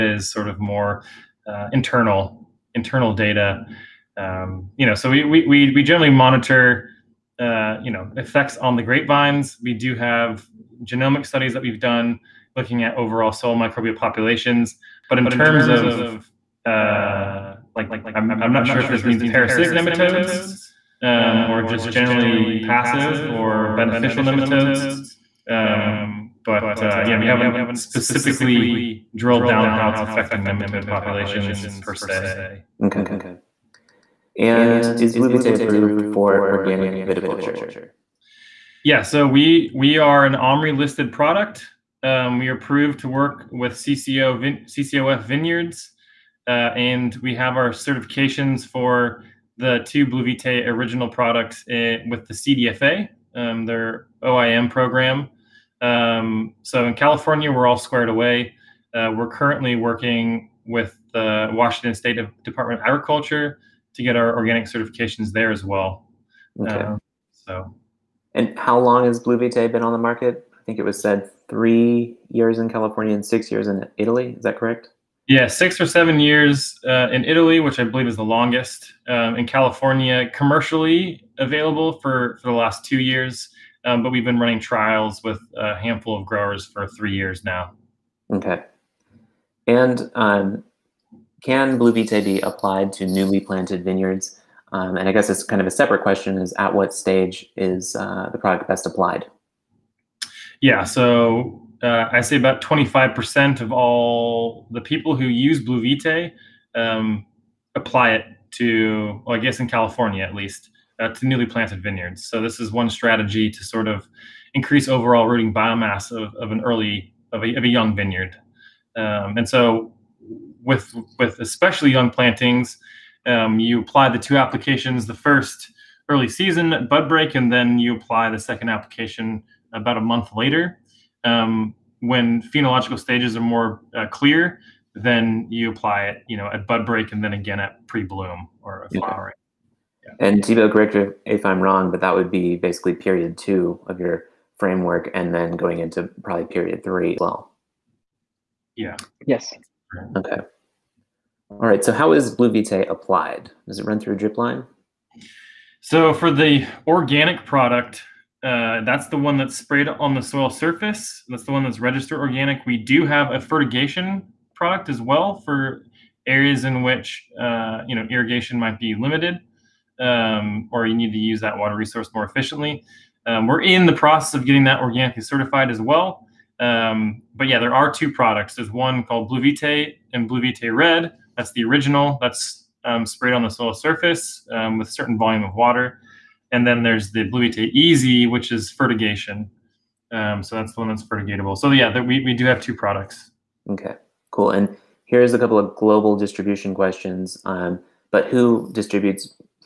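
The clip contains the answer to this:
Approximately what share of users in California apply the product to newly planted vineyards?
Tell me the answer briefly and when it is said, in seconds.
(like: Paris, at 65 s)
25%, at 102 s.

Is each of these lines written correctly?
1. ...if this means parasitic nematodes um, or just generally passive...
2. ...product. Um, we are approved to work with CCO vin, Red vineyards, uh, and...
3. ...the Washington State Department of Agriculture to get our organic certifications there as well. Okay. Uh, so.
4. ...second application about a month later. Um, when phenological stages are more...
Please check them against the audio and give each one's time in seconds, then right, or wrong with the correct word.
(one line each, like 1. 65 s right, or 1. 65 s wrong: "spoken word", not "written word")
1. 18 s right
2. 41 s wrong: "CCOF", not "Red"
3. 61 s right
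4. 128 s right.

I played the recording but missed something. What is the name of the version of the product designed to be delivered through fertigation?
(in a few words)
BluVite Easy.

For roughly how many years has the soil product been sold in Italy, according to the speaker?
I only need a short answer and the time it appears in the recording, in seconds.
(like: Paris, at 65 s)
6 or 7 years, at 75 s.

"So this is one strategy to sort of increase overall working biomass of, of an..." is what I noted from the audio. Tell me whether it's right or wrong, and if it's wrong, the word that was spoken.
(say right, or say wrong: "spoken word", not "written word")
wrong: "rooting", not "working".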